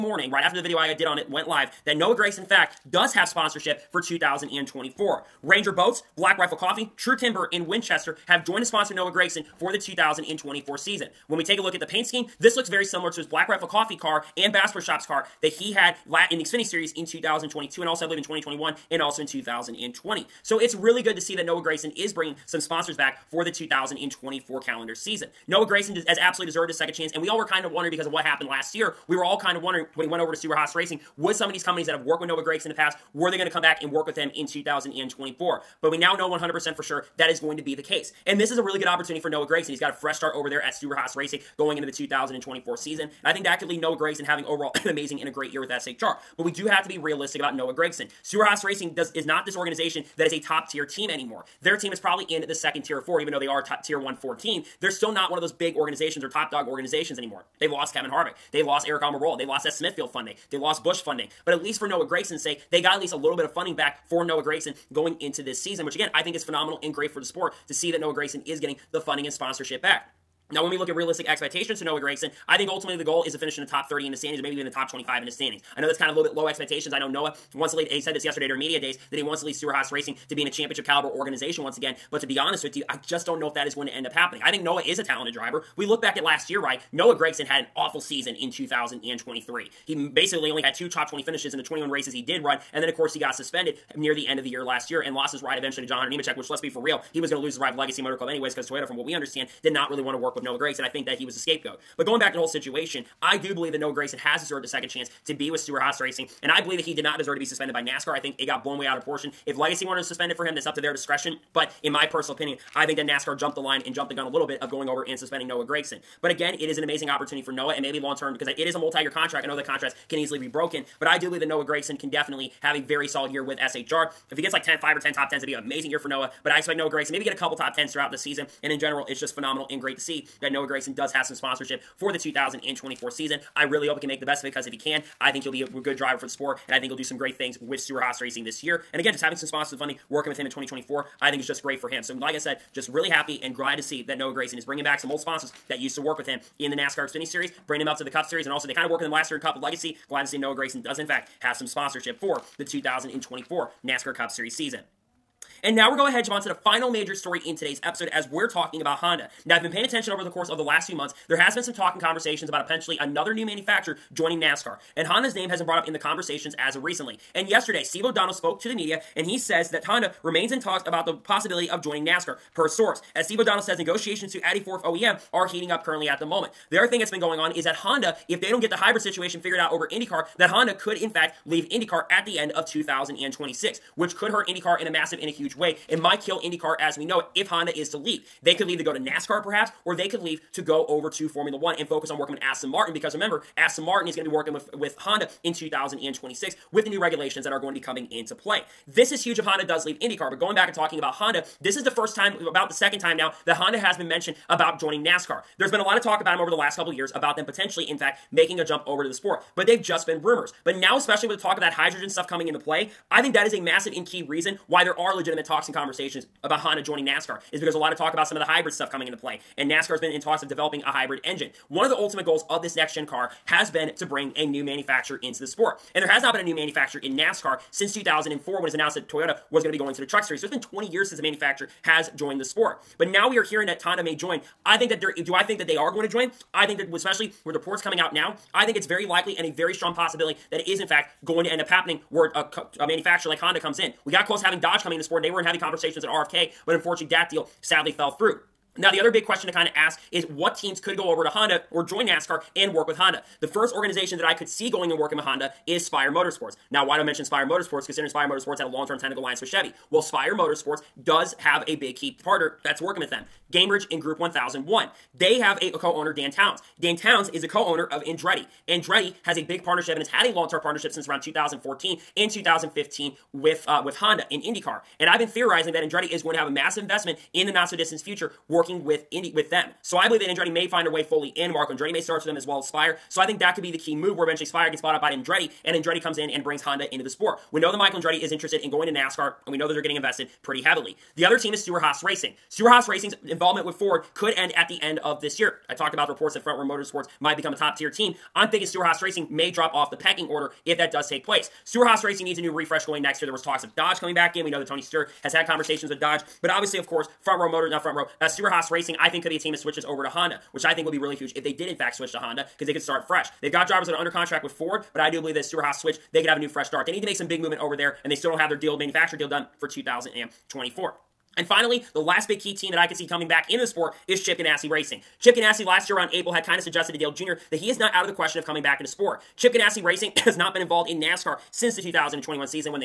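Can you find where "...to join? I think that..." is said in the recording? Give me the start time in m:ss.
3:56.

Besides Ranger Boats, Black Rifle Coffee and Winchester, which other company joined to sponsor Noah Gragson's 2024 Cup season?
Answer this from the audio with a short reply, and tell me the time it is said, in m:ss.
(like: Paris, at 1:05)
True Timber, at 0:06.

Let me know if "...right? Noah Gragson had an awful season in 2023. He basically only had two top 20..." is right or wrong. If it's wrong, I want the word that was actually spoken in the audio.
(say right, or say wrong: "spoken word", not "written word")
right.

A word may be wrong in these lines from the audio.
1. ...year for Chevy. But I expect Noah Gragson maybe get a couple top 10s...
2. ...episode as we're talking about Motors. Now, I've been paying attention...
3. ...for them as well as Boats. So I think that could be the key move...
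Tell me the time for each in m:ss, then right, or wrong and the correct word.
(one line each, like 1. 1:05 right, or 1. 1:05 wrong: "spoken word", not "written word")
1. 2:05 wrong: "Noah", not "Chevy"
2. 2:37 wrong: "Honda", not "Motors"
3. 4:42 wrong: "Spire", not "Boats".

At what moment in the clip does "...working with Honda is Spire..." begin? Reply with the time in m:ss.
4:14.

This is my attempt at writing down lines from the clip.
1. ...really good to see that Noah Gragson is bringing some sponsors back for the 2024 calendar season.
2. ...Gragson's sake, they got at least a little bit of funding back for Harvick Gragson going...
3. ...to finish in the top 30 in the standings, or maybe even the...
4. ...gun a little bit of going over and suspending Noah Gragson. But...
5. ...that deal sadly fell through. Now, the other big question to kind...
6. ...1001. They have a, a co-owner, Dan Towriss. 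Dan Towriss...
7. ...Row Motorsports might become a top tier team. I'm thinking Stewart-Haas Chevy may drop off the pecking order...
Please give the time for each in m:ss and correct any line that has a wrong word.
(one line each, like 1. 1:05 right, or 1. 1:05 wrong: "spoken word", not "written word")
1. 0:20 right
2. 1:02 wrong: "Noah", not "Harvick"
3. 1:13 right
4. 1:54 right
5. 4:07 right
6. 4:24 right
7. 4:56 wrong: "Racing", not "Chevy".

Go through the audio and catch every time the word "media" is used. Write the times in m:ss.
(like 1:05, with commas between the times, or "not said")
1:18, 2:48.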